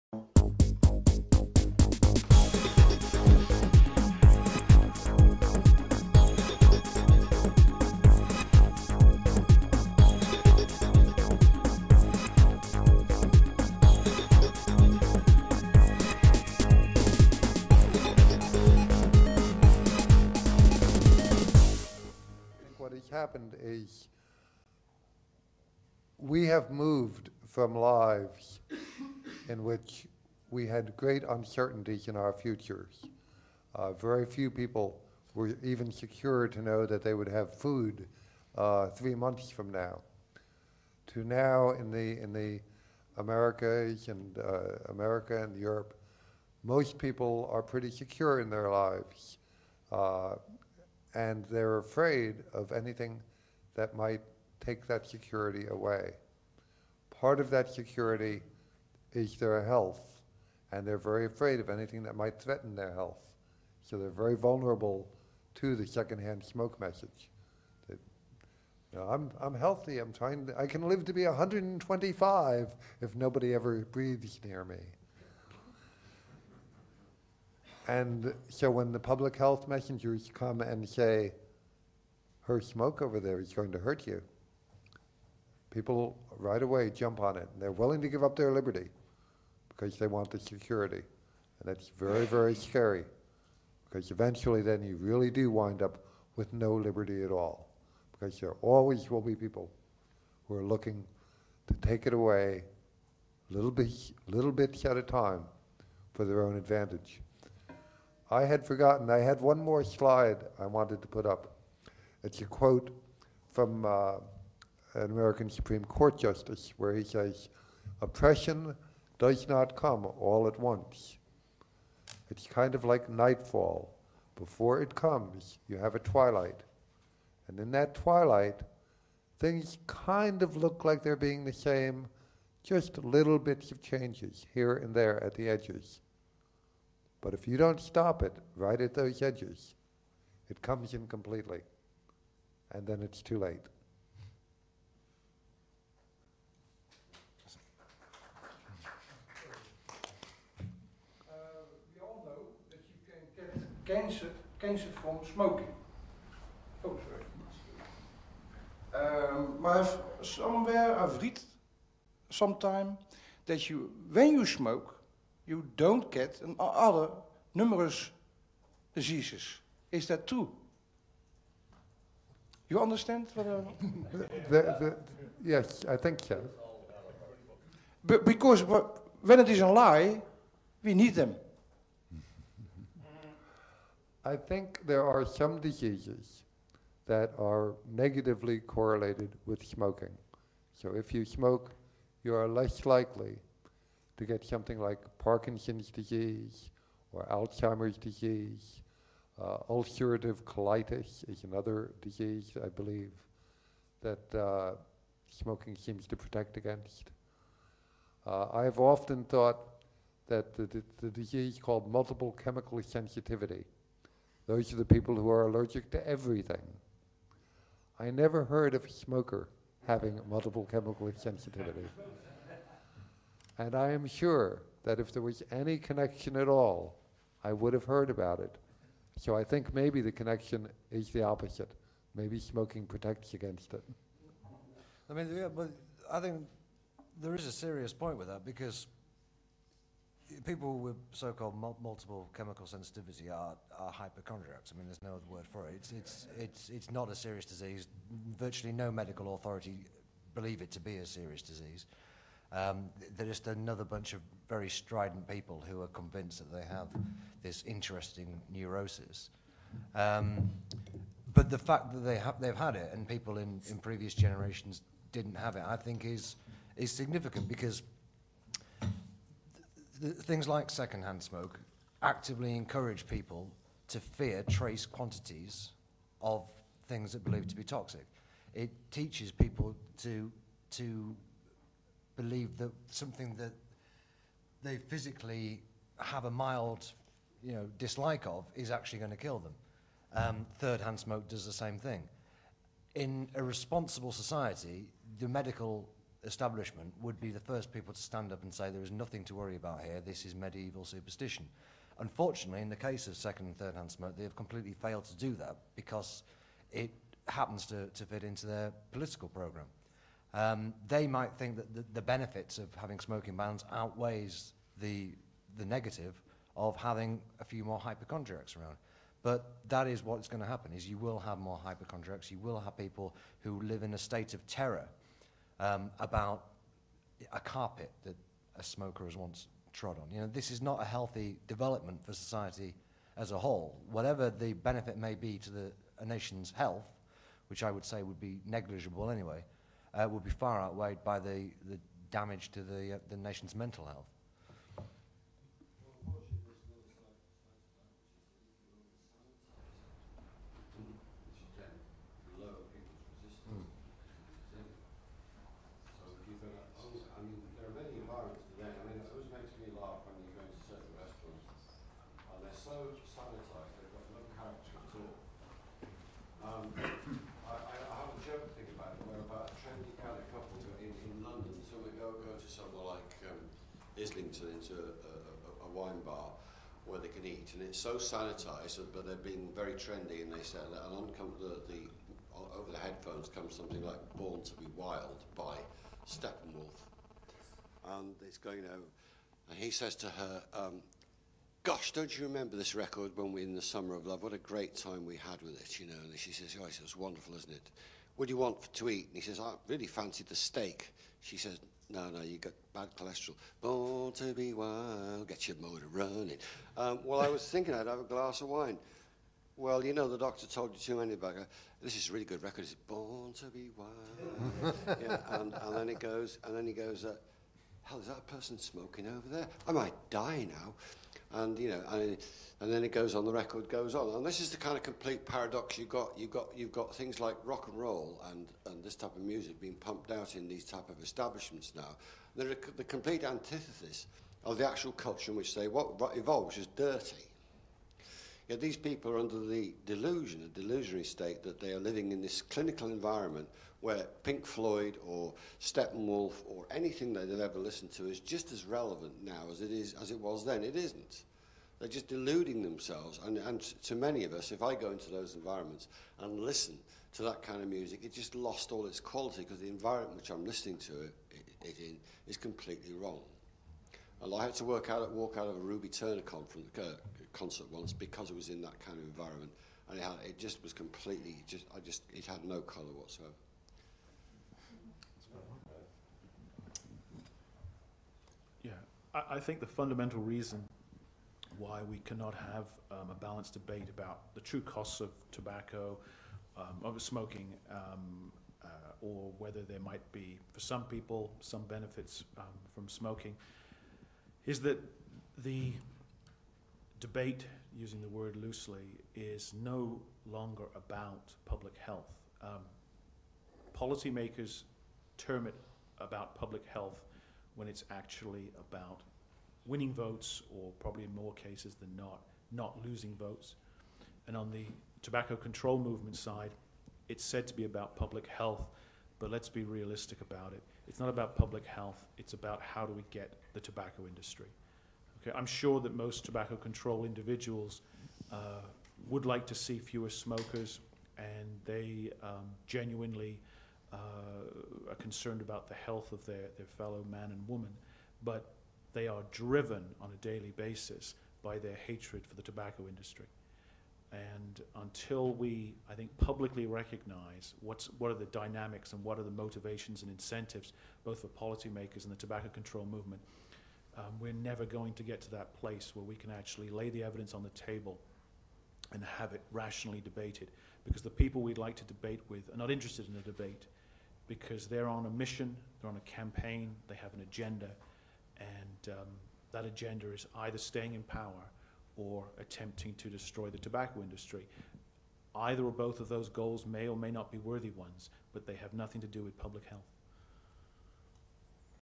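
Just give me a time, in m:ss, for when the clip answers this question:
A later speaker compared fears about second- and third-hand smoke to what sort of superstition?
5:00.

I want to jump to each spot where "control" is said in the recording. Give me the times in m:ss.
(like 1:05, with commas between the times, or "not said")
8:35, 8:46, 9:12.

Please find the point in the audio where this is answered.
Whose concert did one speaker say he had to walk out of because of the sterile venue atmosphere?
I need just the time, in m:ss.
7:45.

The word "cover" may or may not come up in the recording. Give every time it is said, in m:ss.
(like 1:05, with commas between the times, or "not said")
not said.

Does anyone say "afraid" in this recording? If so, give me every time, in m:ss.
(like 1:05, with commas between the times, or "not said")
0:51, 1:01.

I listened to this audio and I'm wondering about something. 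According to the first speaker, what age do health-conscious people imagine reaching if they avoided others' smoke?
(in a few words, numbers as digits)
125.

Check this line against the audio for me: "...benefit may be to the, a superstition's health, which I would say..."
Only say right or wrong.
wrong.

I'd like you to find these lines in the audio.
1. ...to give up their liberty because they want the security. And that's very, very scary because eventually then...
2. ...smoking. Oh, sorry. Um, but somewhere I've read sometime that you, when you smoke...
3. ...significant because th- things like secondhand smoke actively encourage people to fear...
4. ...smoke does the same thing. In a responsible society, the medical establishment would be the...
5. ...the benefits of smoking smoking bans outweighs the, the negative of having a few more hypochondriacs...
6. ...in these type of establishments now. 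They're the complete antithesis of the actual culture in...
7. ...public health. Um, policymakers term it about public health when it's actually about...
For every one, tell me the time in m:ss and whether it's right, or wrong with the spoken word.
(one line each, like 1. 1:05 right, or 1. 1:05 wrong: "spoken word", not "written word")
1. 1:27 right
2. 2:35 right
3. 4:26 right
4. 4:50 right
5. 5:11 wrong: "having", not "smoking"
6. 7:10 right
7. 8:21 right.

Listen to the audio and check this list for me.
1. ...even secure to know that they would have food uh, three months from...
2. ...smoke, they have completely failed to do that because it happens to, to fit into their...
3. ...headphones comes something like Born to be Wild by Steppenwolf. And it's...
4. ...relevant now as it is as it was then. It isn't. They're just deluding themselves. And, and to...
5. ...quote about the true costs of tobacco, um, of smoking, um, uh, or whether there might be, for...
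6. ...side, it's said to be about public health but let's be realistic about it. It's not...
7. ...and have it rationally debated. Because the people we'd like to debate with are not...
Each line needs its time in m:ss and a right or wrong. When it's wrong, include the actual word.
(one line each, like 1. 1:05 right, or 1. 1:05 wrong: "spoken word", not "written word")
1. 0:35 right
2. 5:03 right
3. 6:22 right
4. 7:28 right
5. 8:03 wrong: "debate", not "quote"
6. 8:36 right
7. 9:18 right.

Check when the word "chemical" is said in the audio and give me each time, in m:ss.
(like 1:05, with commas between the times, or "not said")
3:32, 3:40, 4:02.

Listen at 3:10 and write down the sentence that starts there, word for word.
So if you smoke, you are less likely to get something like Parkinson's disease or Alzheimer's disease.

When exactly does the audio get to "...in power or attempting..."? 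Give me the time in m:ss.
9:30.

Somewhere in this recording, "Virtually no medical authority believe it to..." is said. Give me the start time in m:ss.
4:08.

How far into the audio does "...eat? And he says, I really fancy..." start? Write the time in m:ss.
6:38.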